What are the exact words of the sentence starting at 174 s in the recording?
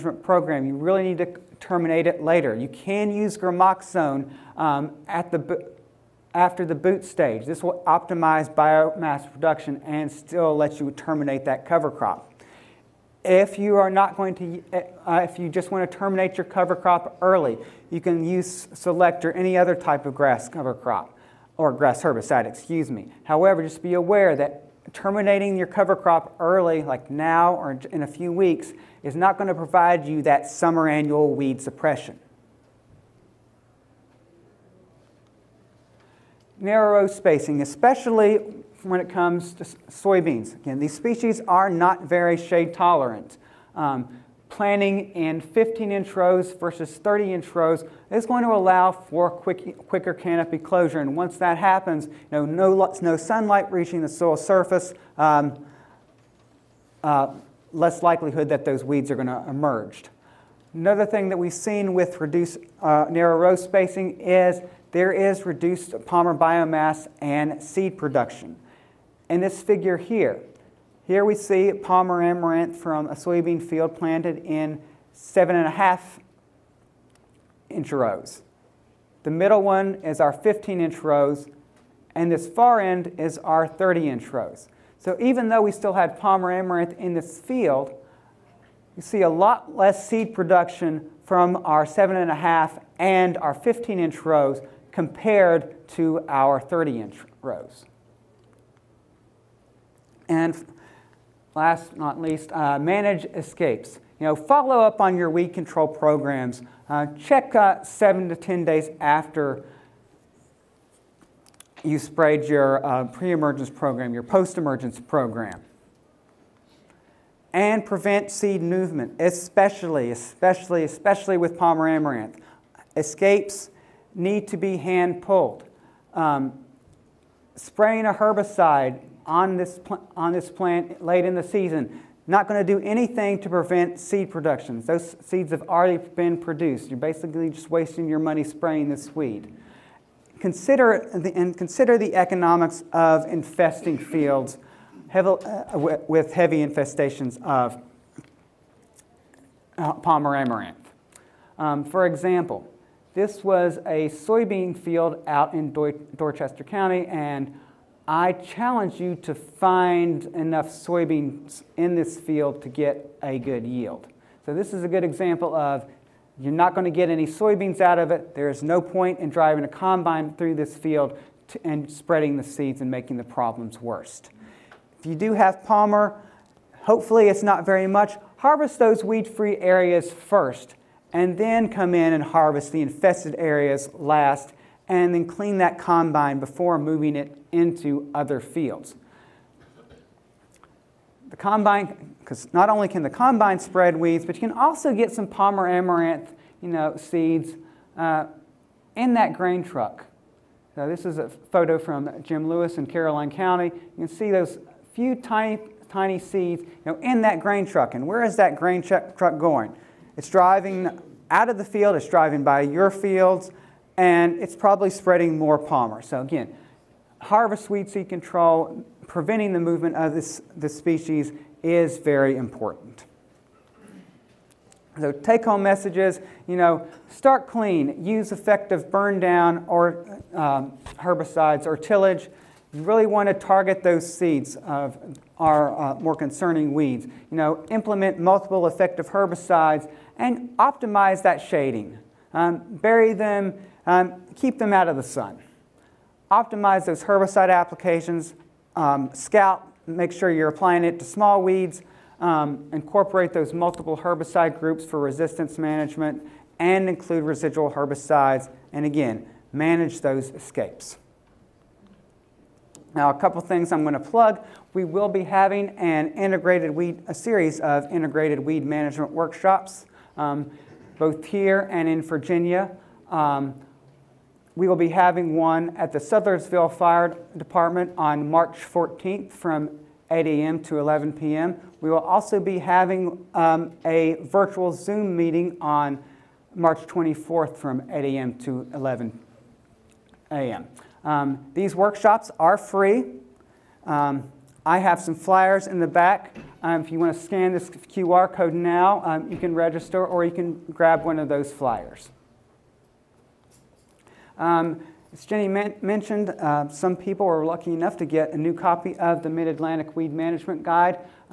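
If you do have Palmer, hopefully it's not very much.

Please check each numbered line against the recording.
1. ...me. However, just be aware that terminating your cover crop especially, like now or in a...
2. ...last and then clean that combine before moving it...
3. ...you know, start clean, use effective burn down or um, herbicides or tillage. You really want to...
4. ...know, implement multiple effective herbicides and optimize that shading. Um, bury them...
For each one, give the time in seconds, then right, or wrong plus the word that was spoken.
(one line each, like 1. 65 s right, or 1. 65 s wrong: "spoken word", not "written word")
1. 22 s wrong: "early", not "especially"
2. 183 s right
3. 226 s right
4. 237 s right.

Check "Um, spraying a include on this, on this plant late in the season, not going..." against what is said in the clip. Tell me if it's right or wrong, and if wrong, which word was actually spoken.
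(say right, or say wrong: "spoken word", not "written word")
wrong: "herbicide", not "include".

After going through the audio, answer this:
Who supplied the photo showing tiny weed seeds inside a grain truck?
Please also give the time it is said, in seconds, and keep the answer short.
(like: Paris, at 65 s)
Jim Lewis, at 202 s.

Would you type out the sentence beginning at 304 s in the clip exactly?
Um, as Jenny mentioned, uh, some people are lucky enough to get a new copy of the Mid-Atlantic Weed Management Guide.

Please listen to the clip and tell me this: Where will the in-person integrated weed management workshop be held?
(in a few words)
Sudlersville Fire Department.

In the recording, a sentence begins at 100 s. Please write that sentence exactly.
And last but not least, uh, manage escapes.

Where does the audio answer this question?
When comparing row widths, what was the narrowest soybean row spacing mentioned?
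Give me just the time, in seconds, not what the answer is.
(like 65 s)
75 s.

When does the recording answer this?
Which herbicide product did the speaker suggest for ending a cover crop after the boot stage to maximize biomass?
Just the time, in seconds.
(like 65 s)
3 s.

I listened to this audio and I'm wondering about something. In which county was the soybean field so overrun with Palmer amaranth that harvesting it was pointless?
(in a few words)
Dorchester County.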